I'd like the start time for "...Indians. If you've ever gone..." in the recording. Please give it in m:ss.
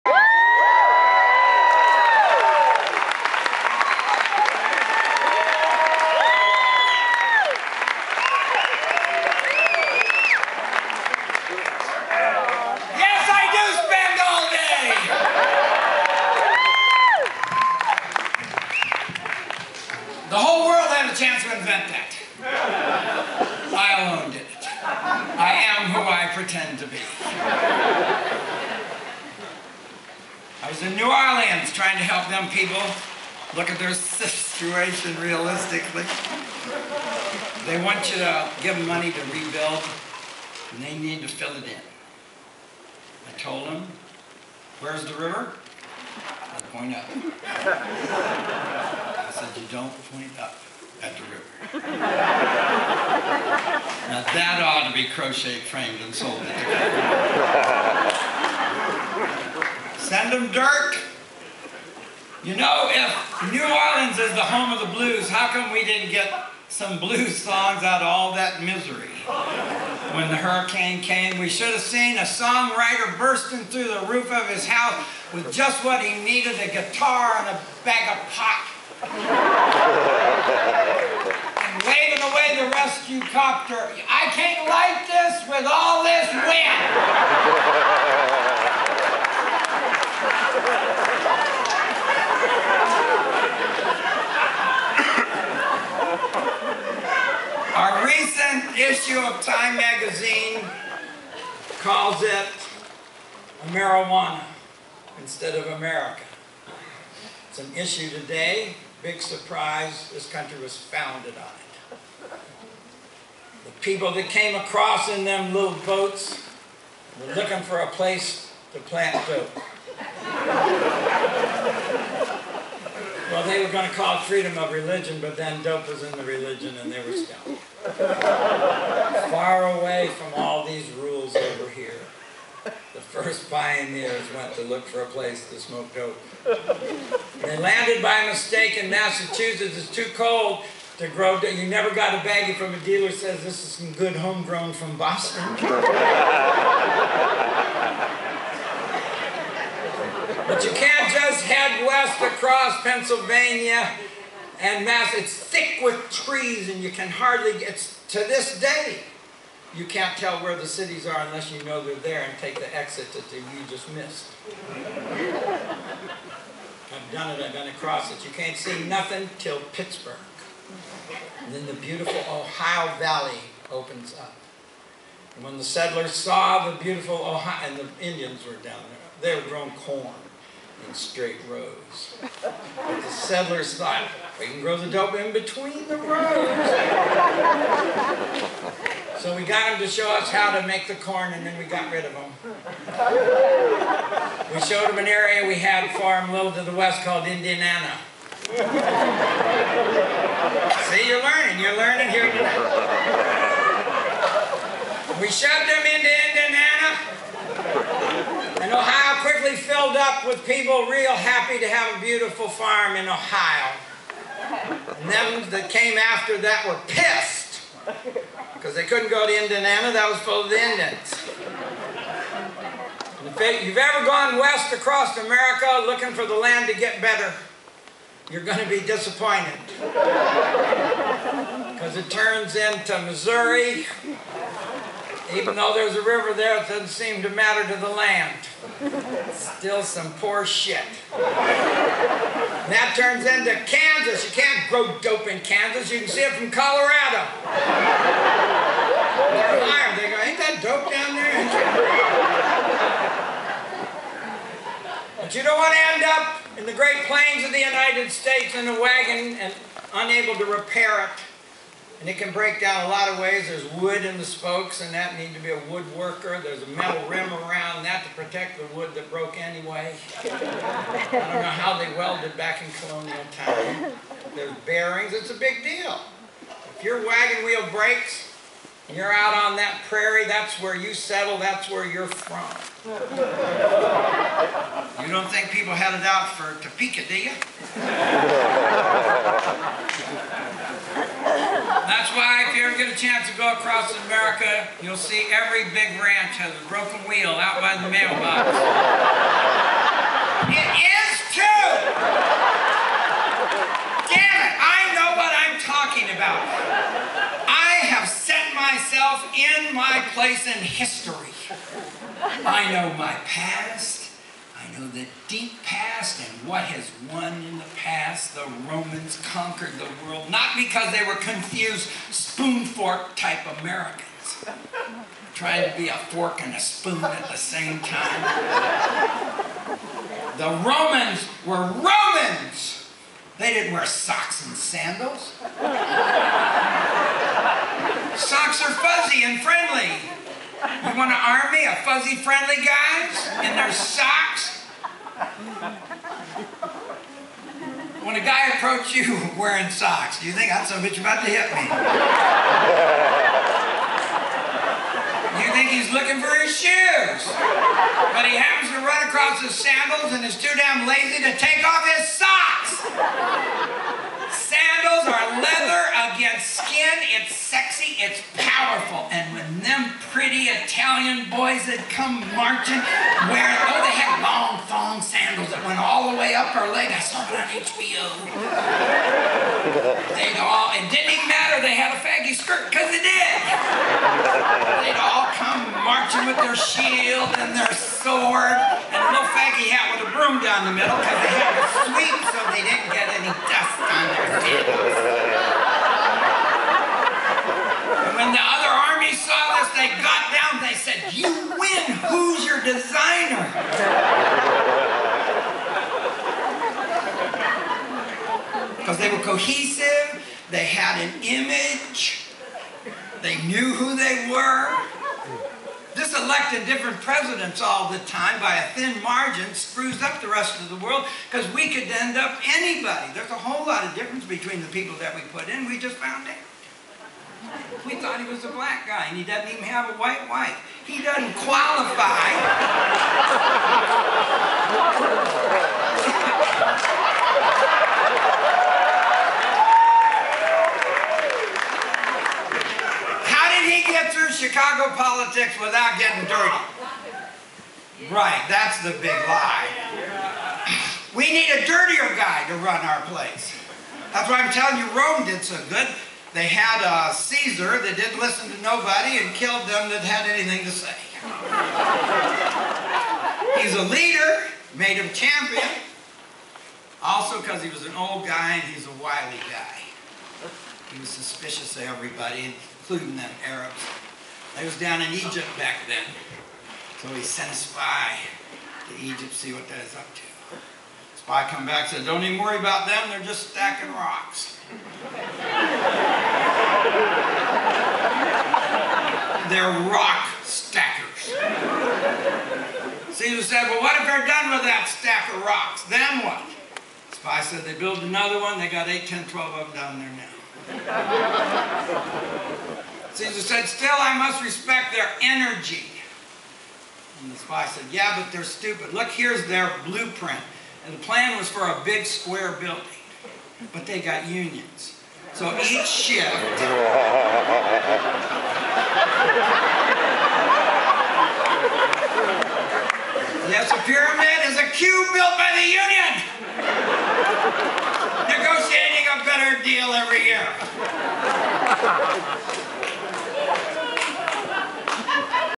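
3:40.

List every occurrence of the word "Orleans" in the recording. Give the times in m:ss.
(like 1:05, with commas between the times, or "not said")
0:31, 1:03.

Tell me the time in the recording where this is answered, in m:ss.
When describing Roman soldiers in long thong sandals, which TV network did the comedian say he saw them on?
6:17.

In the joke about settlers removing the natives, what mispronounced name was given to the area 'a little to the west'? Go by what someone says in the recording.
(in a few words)
Indianana.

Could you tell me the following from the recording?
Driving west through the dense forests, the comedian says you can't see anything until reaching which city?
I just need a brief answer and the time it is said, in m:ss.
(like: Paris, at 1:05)
Pittsburgh, at 2:49.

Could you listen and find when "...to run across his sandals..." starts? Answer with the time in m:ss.
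5:58.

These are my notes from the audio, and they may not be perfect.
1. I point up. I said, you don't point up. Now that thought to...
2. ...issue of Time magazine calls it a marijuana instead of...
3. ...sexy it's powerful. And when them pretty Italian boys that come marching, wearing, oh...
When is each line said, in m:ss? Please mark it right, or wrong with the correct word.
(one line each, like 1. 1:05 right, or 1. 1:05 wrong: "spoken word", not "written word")
1. 0:46 wrong: "ought", not "thought"
2. 1:38 right
3. 6:07 right.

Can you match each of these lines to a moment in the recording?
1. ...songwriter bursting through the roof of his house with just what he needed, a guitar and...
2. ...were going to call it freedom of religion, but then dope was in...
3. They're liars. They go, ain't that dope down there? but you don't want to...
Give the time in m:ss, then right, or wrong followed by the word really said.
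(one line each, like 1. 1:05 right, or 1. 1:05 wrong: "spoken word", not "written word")
1. 1:12 right
2. 2:03 right
3. 4:09 right.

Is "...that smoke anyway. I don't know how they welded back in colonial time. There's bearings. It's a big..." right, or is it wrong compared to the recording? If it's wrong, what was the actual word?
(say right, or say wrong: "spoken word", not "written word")
wrong: "broke", not "smoke".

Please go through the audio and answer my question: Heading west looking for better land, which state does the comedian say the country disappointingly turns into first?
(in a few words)
Missouri.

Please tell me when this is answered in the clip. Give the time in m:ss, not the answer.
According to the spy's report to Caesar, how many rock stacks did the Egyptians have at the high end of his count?
8:19.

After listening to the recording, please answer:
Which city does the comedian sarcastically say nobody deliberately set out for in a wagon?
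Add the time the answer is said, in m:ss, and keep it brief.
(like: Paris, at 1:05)
Topeka, at 4:46.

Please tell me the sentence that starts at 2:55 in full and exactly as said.
And when the settlers saw the beautiful Ohio, and the Indians were down there, they were growing corn in straight rows.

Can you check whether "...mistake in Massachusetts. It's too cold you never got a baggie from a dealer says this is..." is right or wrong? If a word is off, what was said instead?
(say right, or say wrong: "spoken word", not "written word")
right.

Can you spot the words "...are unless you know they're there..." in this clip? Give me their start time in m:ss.
2:41.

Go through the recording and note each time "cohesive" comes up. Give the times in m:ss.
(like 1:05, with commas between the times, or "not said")
6:49.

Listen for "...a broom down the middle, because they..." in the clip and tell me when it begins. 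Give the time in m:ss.
6:30.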